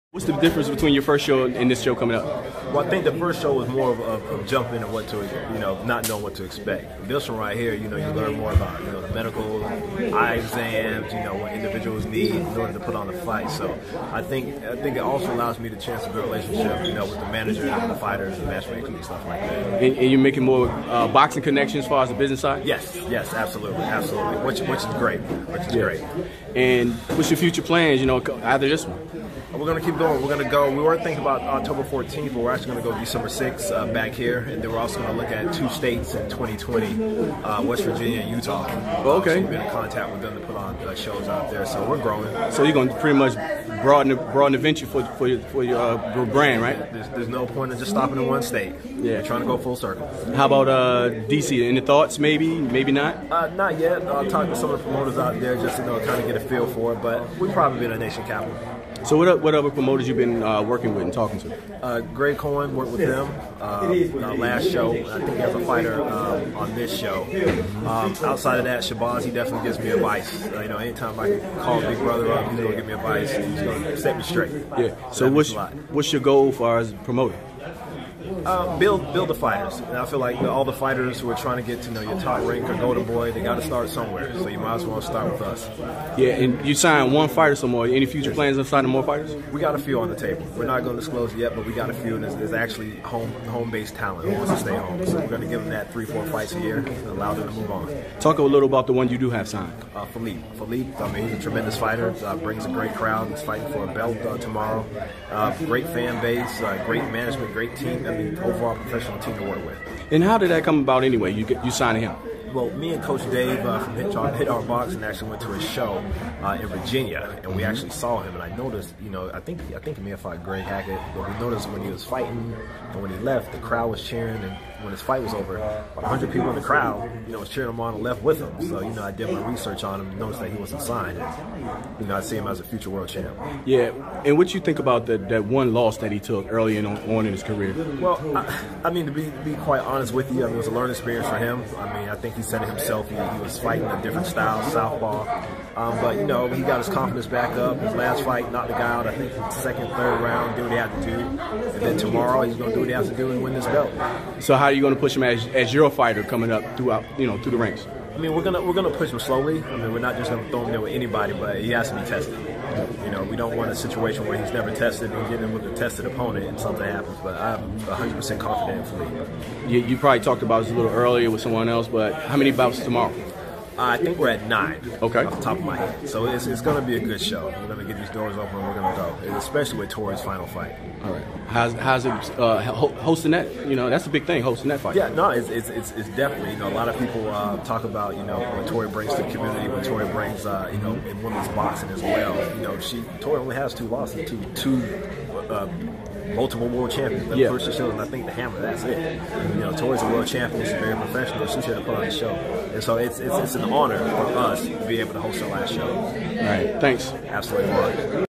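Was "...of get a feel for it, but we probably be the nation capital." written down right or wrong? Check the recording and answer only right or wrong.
right.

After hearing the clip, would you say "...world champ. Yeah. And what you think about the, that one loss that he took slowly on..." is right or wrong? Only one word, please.
wrong.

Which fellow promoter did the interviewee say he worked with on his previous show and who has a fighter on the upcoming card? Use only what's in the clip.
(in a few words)
Greg Cohen.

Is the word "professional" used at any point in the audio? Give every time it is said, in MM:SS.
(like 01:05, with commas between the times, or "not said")
01:48, 03:20.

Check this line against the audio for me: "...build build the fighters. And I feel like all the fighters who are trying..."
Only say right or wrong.
right.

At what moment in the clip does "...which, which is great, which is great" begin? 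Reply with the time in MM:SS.
00:24.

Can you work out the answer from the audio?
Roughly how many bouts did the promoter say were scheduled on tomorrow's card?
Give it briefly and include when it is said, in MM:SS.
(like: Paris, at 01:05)
9, at 02:54.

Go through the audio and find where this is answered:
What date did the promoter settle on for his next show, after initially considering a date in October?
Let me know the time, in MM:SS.
00:32.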